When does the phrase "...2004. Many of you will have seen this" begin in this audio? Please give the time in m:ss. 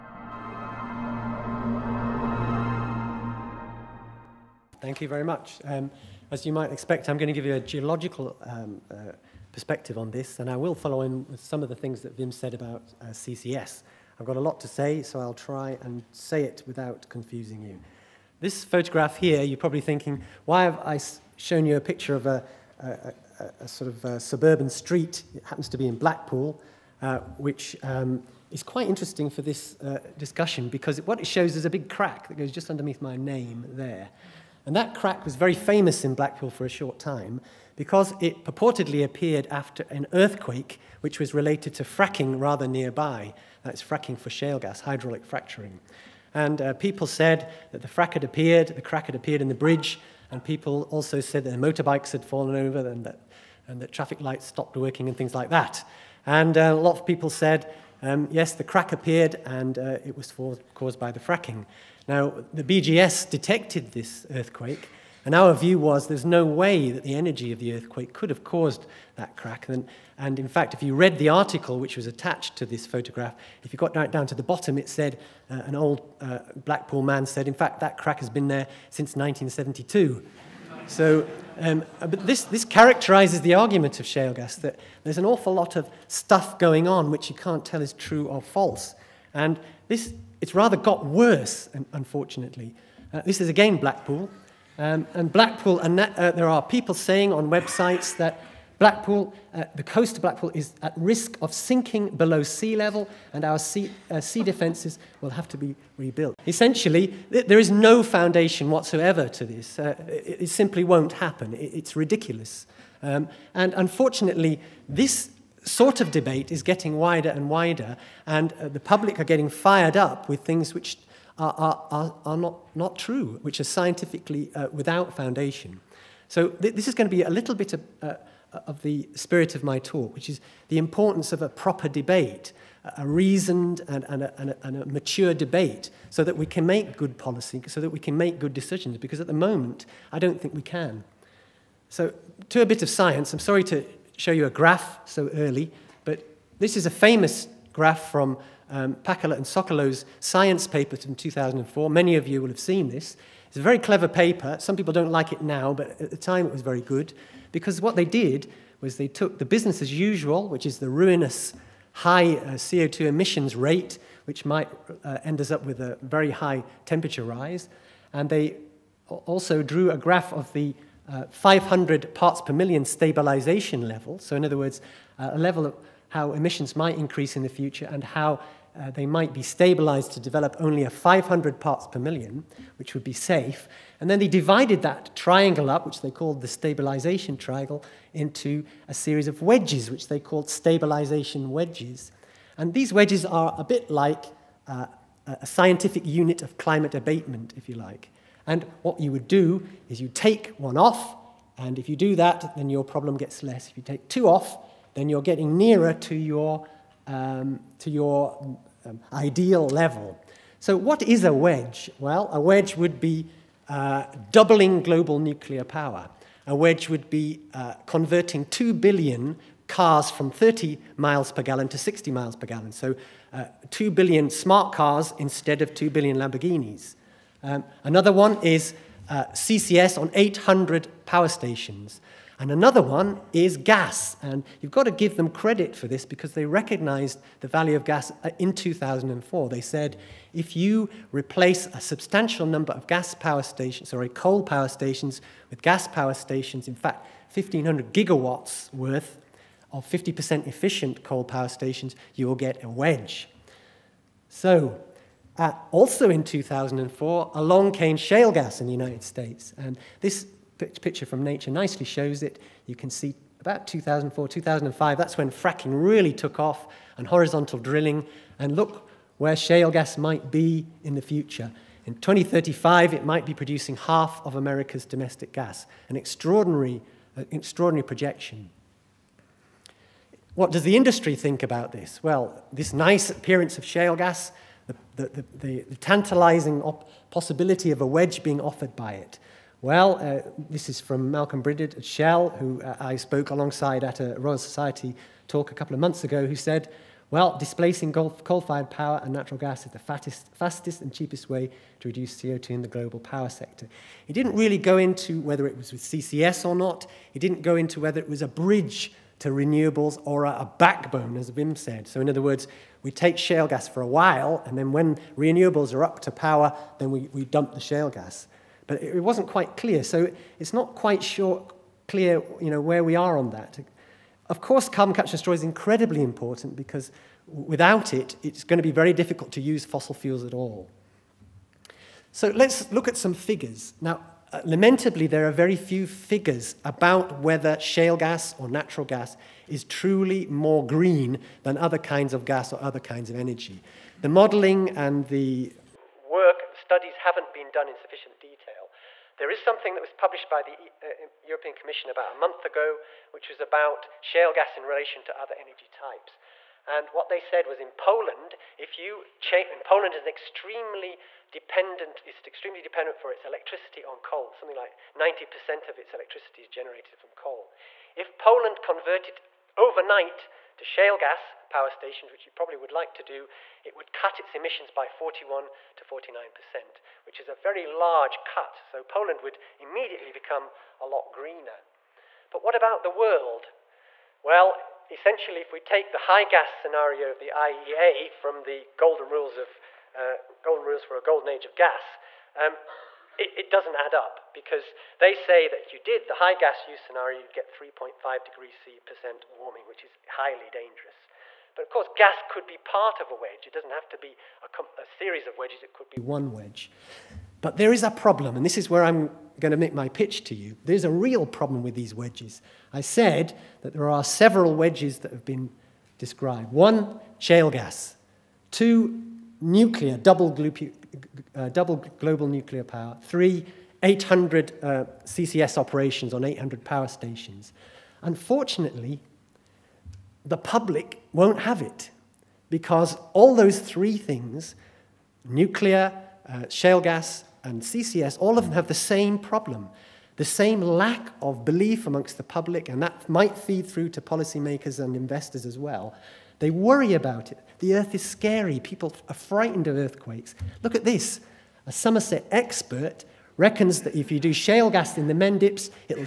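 2:31.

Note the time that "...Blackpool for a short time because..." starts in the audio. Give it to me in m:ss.
0:36.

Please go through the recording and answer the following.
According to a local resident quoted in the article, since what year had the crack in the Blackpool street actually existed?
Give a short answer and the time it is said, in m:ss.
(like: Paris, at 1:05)
1972, at 1:19.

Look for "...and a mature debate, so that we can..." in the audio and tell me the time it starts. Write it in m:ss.
2:14.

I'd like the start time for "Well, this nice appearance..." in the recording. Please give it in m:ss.
4:42.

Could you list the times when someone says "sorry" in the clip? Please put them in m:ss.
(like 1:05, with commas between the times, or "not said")
2:23, 4:03.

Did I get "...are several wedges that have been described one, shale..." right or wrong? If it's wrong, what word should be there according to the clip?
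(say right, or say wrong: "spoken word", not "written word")
right.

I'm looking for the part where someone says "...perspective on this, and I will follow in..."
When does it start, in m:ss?
0:09.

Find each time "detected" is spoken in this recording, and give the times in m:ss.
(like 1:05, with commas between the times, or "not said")
1:03.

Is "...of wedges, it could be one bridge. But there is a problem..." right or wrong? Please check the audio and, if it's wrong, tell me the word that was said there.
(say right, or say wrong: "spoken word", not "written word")
wrong: "wedge", not "bridge".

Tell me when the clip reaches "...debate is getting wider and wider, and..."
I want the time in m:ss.
1:56.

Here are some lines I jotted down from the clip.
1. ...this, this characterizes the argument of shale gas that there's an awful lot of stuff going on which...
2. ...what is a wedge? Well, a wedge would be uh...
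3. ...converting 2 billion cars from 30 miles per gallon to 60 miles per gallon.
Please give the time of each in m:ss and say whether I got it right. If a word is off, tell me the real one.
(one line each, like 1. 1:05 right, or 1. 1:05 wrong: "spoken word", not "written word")
1. 1:22 right
2. 3:30 right
3. 3:37 right.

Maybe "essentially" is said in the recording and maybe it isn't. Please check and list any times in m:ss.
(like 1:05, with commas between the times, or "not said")
1:46, 6:24.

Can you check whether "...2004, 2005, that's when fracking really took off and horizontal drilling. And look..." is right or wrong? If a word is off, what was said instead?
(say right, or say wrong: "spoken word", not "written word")
right.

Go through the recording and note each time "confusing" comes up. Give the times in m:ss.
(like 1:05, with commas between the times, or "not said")
0:17.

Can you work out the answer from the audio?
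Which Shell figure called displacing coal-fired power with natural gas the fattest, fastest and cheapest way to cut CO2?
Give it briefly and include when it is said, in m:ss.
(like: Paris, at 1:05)
Malcolm Brinded, at 4:51.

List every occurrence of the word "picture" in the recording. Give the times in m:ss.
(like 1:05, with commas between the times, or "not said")
0:21, 4:20.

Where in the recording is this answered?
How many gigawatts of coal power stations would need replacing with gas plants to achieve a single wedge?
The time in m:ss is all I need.
4:07.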